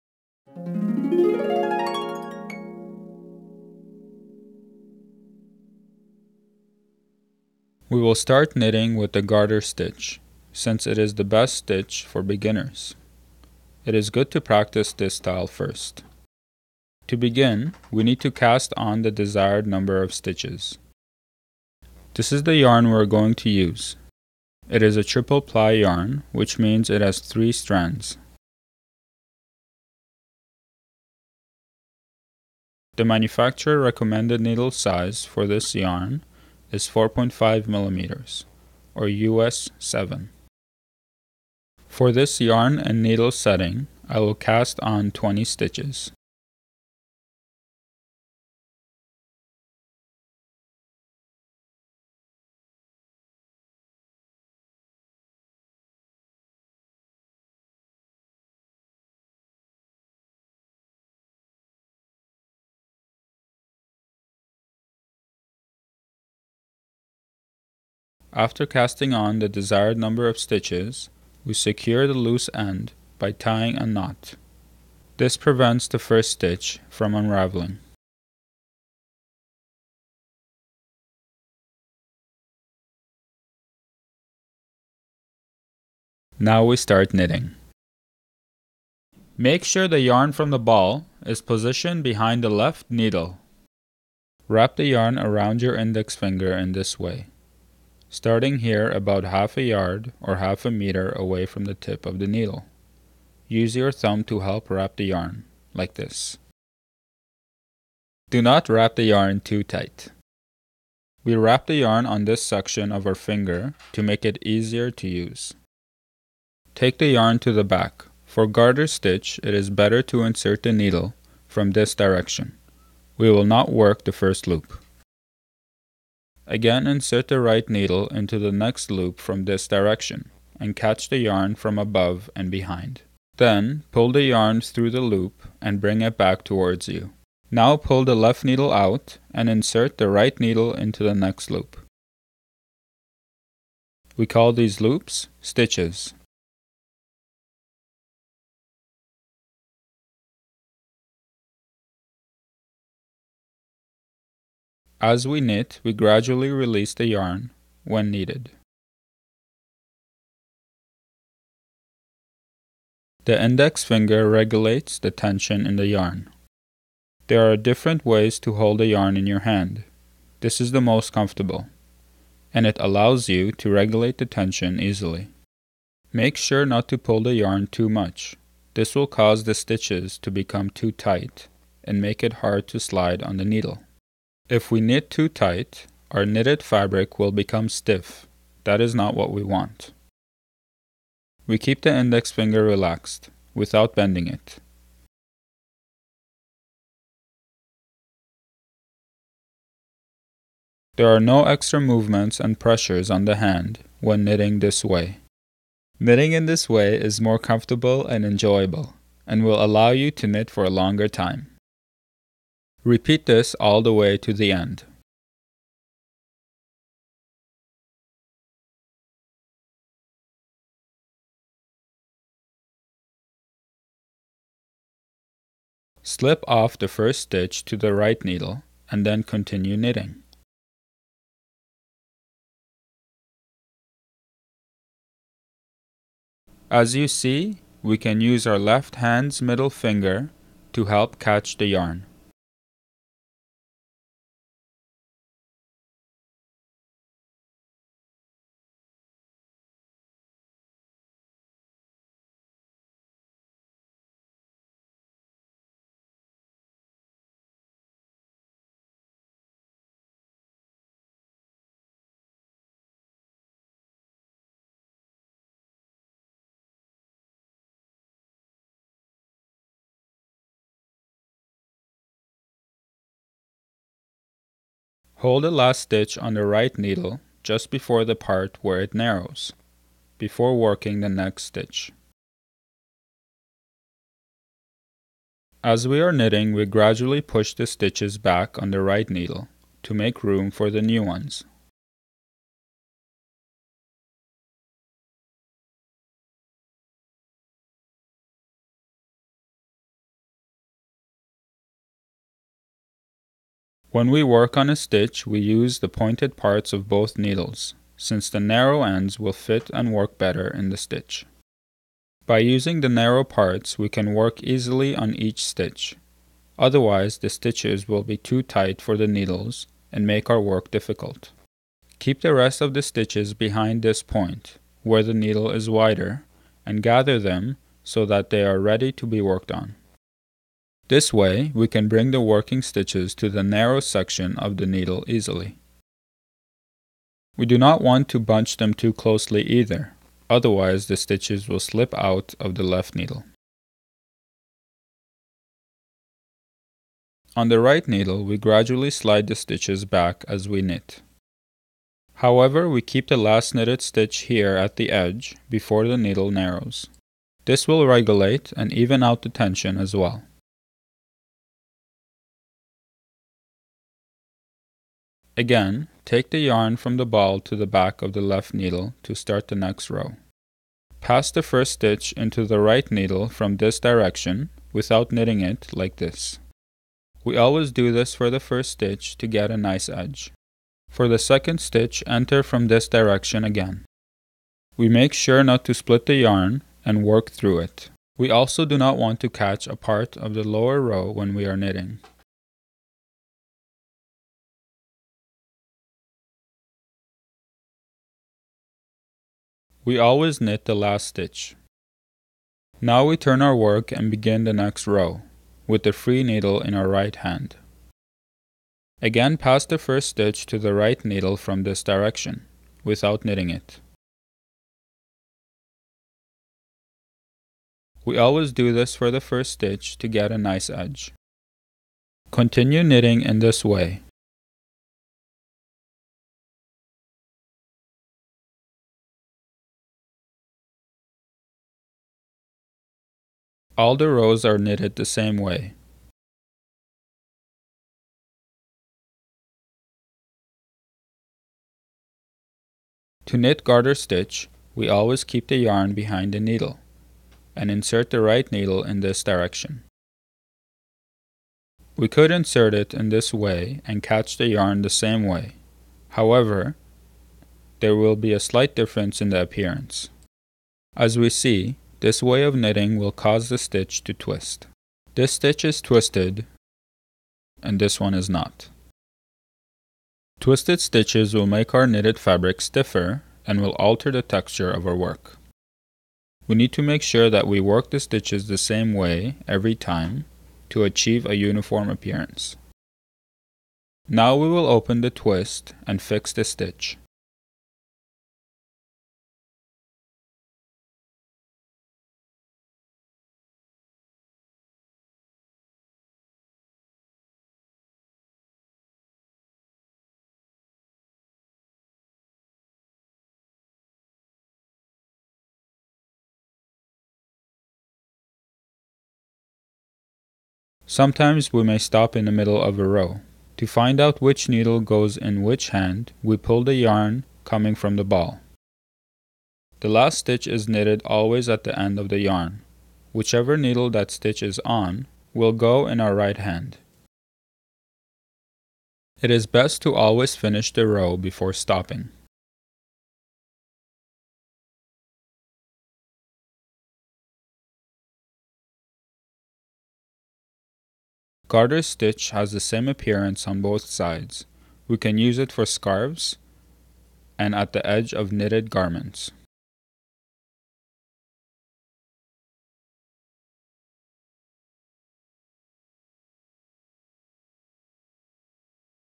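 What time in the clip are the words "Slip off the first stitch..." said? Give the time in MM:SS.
03:46.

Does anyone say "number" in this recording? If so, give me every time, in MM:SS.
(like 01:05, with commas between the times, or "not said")
00:19, 01:09.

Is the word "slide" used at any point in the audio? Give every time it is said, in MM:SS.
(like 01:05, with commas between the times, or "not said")
03:02, 05:48.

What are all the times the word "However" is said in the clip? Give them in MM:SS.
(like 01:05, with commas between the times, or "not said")
05:52, 07:36.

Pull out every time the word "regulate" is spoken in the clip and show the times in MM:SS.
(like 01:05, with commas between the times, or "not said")
02:44, 02:53, 05:57.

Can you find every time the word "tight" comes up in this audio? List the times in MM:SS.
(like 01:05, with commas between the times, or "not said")
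01:49, 03:00, 03:05, 05:18.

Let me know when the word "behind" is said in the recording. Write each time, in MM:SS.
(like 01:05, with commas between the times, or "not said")
01:32, 02:12, 05:23, 07:25.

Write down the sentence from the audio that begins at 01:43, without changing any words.
Use your thumb to help wrap the yarn, like this.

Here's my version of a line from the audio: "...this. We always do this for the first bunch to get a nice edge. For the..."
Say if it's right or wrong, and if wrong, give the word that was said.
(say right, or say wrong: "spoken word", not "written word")
wrong: "stitch", not "bunch".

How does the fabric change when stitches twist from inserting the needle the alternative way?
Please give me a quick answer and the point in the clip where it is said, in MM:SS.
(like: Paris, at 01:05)
stiffer, at 07:52.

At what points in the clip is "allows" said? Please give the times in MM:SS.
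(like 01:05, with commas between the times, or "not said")
02:52, 03:29.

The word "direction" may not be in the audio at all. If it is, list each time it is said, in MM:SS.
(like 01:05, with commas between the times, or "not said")
02:01, 02:09, 06:13, 06:22, 06:51, 07:29.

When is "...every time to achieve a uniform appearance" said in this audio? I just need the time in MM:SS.
07:59.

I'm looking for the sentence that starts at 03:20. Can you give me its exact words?
There are no extra movements and pressures on the hand when knitting this way.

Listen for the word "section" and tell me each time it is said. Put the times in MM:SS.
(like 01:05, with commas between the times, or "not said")
01:52, 05:33.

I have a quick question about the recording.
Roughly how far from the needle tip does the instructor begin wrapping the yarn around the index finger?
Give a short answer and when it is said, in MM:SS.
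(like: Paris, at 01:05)
half a yard, at 01:39.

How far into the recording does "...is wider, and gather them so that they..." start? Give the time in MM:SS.
05:25.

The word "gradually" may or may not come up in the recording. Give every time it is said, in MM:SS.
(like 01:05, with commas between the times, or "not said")
02:35, 04:46, 05:48.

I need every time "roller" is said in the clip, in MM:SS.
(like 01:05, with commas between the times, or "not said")
not said.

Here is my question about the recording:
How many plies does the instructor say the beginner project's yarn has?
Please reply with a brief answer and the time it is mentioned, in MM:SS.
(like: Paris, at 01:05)
3, at 00:27.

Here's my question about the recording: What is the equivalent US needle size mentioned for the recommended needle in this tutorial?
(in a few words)
US 7.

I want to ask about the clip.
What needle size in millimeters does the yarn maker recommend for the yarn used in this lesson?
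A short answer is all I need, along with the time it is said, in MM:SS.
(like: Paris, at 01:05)
4.5 millimeters, at 00:36.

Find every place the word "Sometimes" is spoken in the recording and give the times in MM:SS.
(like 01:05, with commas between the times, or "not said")
08:30.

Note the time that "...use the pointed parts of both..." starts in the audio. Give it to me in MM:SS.
05:05.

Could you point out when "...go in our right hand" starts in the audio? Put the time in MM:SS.
08:45.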